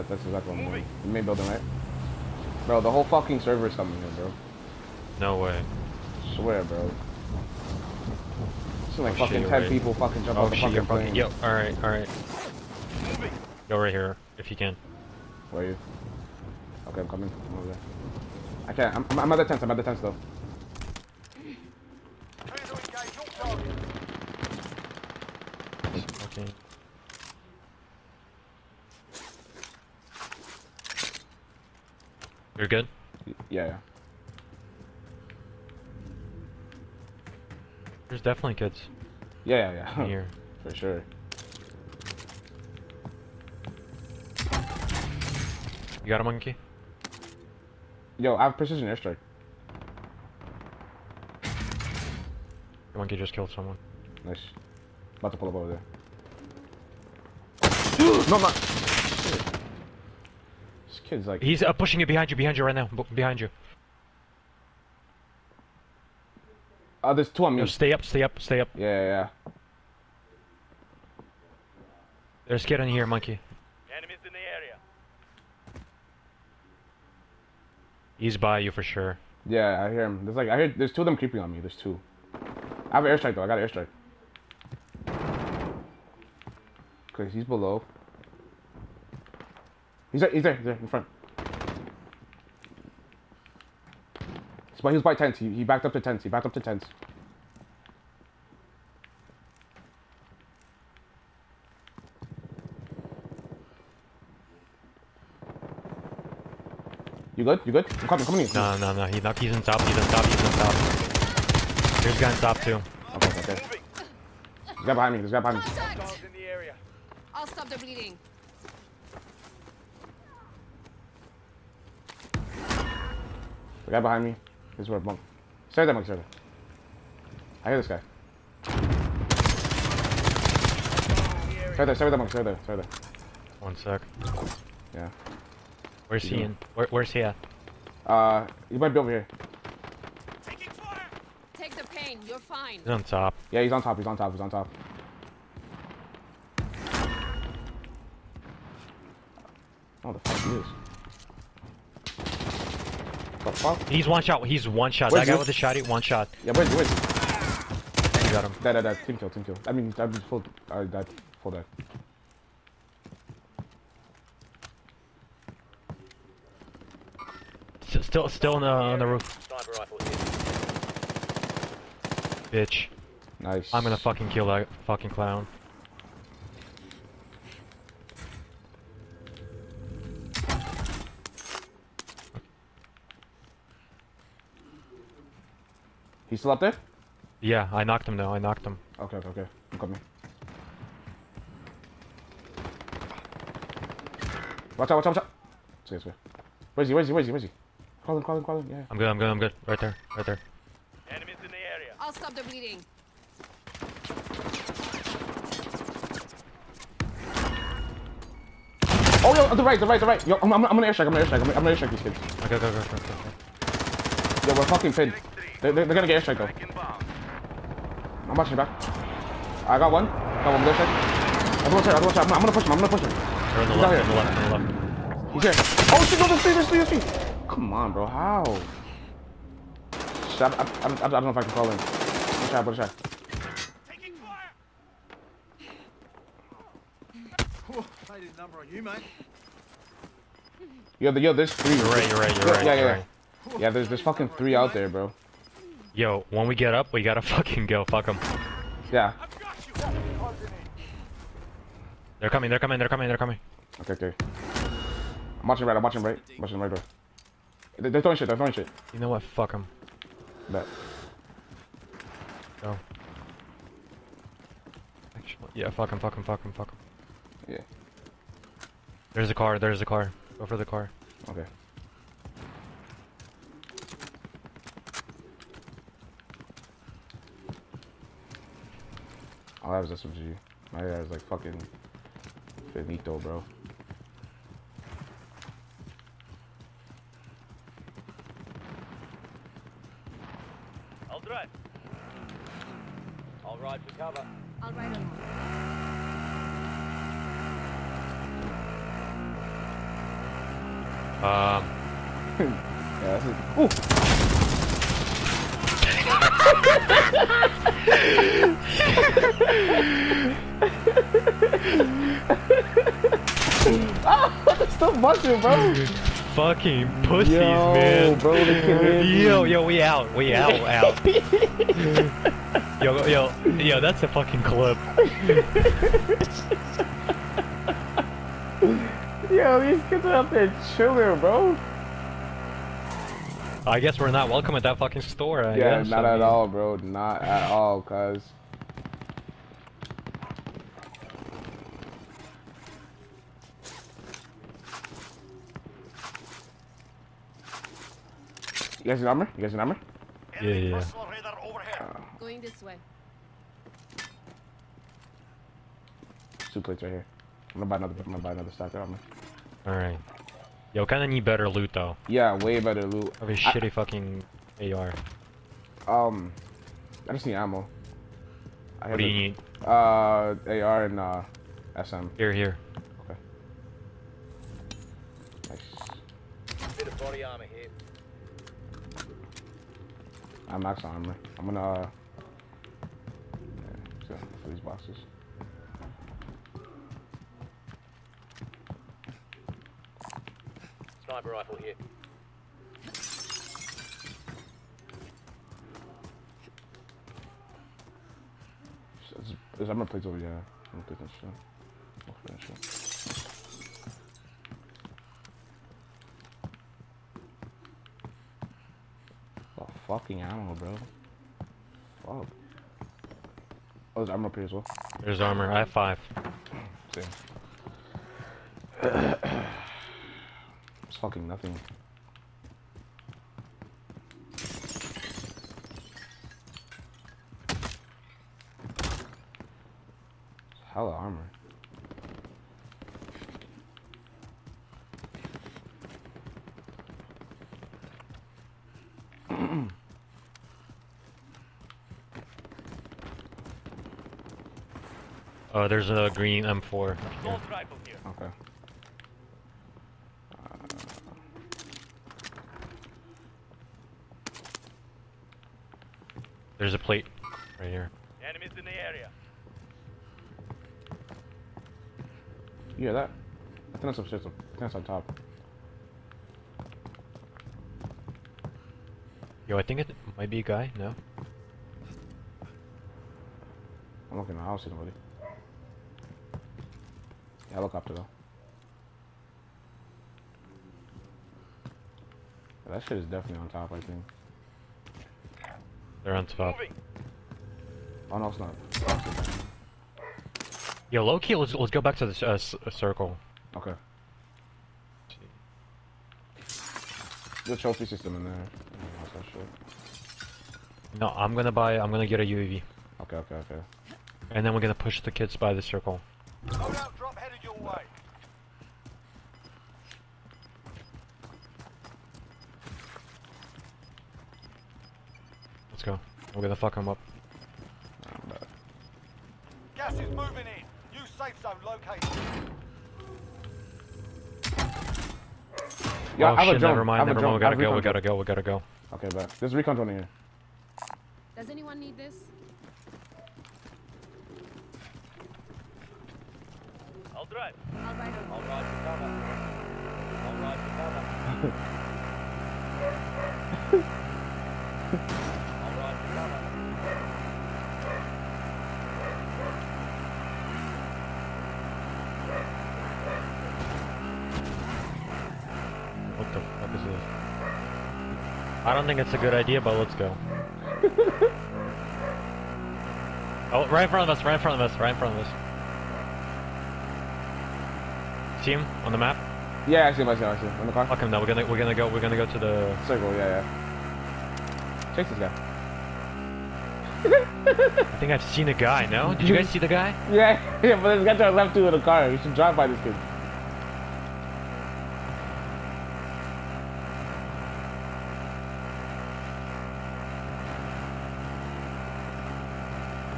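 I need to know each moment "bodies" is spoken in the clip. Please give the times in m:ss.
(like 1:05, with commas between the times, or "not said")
not said.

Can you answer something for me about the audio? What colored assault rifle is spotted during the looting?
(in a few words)
green M4.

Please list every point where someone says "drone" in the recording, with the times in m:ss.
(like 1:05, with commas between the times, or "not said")
8:49.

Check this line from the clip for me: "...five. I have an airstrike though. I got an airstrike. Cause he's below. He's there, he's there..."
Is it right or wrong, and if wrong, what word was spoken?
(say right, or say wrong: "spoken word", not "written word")
wrong: "two", not "five".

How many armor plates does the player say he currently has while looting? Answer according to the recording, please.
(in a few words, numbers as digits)
5.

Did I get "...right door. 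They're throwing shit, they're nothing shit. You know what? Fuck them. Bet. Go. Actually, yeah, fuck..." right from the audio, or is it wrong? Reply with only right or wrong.
wrong.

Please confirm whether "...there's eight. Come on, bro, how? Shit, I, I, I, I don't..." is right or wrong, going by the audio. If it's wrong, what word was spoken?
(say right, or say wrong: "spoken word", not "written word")
wrong: "three", not "eight".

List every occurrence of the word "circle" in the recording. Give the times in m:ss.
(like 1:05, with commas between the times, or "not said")
8:12, 8:25, 9:32.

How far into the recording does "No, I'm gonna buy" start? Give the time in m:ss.
8:20.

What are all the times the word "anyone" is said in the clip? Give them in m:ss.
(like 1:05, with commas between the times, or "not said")
8:51.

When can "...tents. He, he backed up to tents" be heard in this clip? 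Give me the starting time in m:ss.
1:35.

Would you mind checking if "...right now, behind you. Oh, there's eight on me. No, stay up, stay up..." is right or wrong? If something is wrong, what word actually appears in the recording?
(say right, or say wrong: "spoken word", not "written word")
wrong: "two", not "eight".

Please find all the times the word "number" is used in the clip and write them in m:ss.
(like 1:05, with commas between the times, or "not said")
3:58, 5:49.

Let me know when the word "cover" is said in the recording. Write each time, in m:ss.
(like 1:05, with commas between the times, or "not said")
4:53, 8:58, 9:03.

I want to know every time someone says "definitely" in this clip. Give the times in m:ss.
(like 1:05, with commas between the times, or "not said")
0:38, 8:03.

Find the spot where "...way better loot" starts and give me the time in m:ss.
6:02.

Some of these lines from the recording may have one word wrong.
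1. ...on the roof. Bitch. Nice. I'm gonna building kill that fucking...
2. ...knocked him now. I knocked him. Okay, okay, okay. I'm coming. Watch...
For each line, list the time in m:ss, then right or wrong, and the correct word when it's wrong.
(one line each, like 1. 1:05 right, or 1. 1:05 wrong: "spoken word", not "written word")
1. 2:48 wrong: "fucking", not "building"
2. 3:07 right.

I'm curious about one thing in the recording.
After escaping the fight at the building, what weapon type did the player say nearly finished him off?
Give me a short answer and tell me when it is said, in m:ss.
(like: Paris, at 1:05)
SMG, at 4:39.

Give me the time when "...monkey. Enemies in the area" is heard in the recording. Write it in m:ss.
1:13.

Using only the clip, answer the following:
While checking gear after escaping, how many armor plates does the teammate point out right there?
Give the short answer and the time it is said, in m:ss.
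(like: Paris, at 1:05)
2, at 5:56.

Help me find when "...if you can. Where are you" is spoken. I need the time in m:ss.
0:14.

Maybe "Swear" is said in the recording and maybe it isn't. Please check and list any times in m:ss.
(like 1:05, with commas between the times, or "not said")
0:06.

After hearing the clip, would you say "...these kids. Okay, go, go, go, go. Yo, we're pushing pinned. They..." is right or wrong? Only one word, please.
wrong.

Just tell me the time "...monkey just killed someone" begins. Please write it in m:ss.
0:52.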